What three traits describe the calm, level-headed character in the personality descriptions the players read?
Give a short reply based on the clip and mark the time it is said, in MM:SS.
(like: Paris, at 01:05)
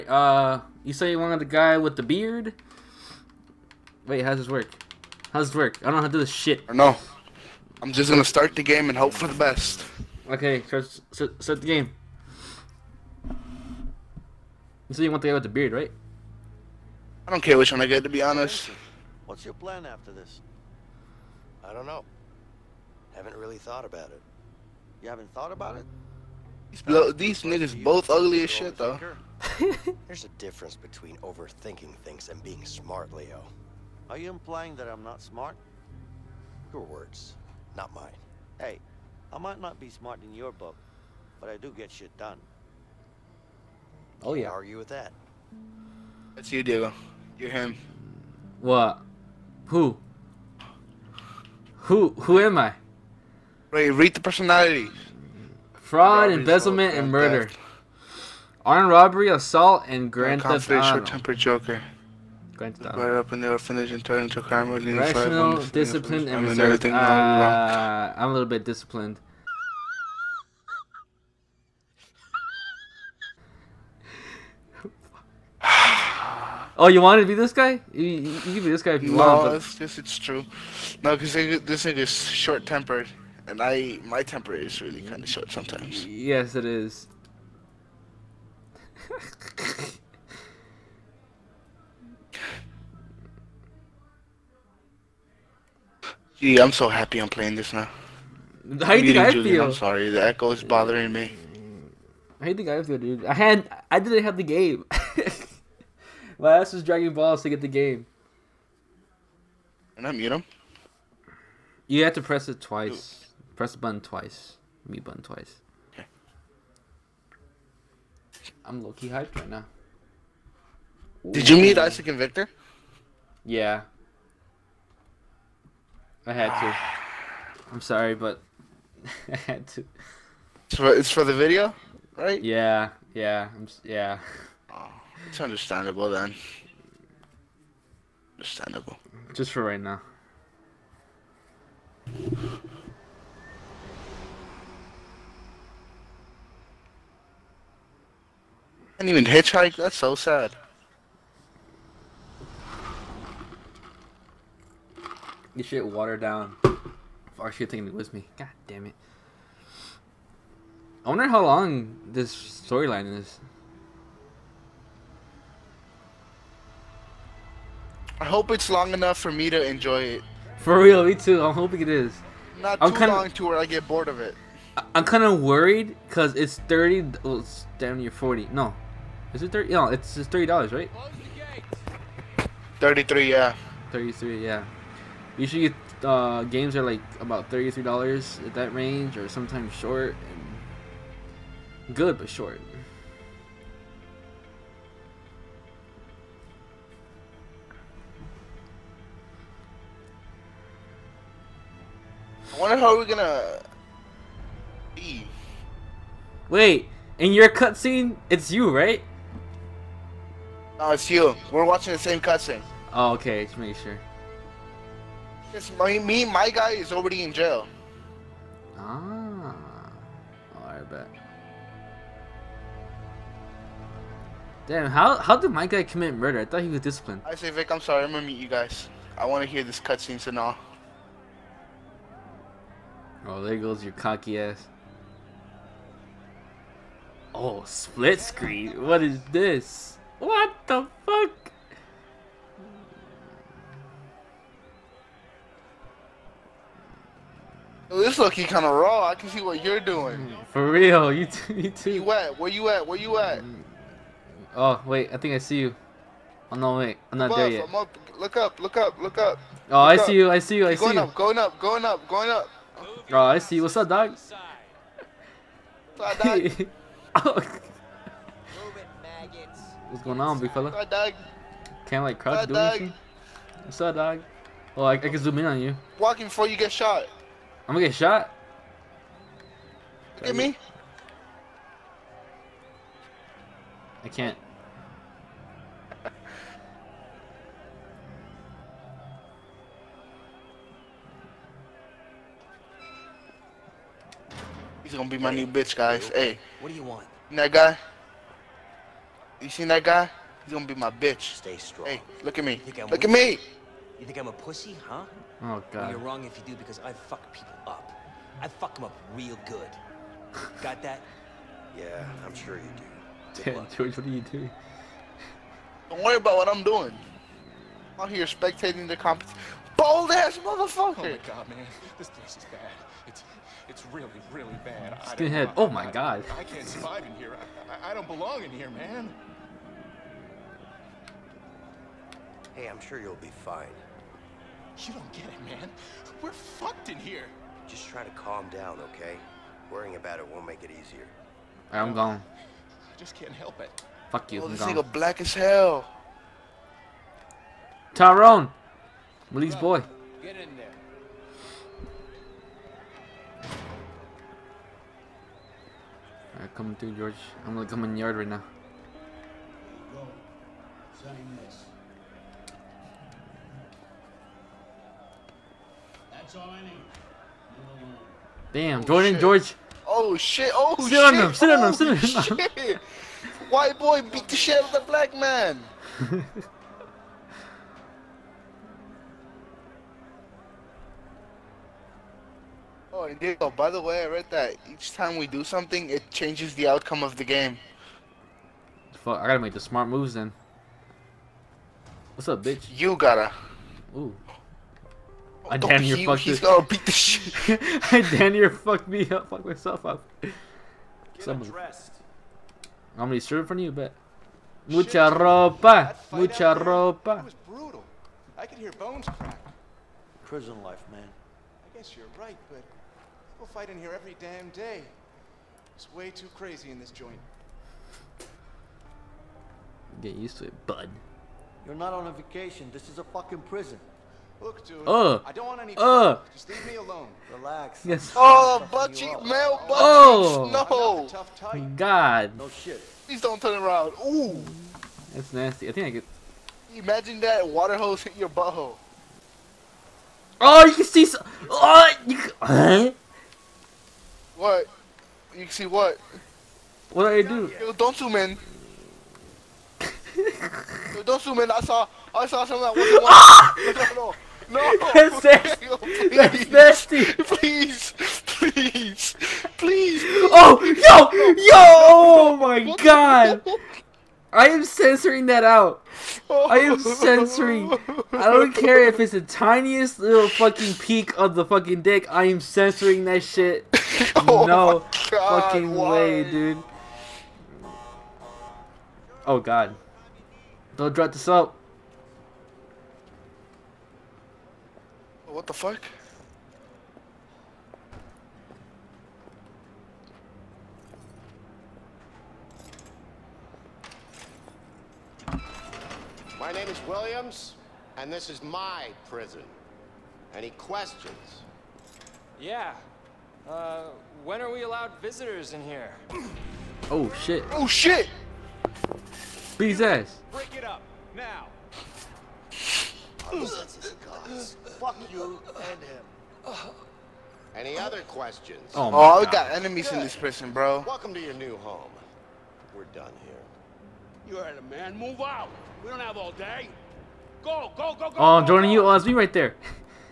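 Rational, disciplined, and reserved, at 01:04.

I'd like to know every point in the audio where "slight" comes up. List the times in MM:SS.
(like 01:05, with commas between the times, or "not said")
not said.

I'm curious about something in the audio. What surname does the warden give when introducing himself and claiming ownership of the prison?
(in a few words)
Williams.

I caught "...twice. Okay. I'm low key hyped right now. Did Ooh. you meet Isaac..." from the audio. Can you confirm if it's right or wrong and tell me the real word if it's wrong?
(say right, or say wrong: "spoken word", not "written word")
right.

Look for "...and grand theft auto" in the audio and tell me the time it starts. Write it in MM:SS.
00:59.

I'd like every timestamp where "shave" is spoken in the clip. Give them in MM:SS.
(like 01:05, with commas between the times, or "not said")
not said.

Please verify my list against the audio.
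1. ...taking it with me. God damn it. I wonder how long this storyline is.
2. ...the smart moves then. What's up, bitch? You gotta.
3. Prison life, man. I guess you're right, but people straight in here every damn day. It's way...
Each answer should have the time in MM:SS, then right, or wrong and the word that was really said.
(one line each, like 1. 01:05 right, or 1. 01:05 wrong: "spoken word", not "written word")
1. 02:37 right
2. 06:29 right
3. 06:50 wrong: "fight", not "straight".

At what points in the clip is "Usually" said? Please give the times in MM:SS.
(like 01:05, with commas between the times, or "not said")
03:05.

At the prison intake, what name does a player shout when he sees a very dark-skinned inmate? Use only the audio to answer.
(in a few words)
Tyrone.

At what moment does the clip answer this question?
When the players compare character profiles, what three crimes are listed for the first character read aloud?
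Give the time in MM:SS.
00:55.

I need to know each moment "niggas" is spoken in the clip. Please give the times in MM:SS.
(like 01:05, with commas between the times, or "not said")
00:27, 05:44.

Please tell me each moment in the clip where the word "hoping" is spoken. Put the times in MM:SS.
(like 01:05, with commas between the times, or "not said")
02:51.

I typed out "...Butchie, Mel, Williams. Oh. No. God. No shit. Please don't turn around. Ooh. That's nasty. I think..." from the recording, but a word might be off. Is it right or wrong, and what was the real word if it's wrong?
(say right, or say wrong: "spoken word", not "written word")
wrong: "Butchie", not "Williams".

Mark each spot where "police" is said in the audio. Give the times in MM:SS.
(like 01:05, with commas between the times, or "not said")
05:49.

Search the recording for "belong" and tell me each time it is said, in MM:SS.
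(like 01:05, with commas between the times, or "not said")
05:28.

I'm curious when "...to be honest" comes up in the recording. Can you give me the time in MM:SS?
00:18.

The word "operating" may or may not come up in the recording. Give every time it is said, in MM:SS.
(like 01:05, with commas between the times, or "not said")
not said.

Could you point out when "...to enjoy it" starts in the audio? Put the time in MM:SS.
02:49.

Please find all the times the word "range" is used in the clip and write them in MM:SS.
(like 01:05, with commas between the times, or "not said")
03:08.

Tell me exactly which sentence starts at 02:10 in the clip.
It's for, it's for the video, right?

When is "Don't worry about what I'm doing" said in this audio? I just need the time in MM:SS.
05:15.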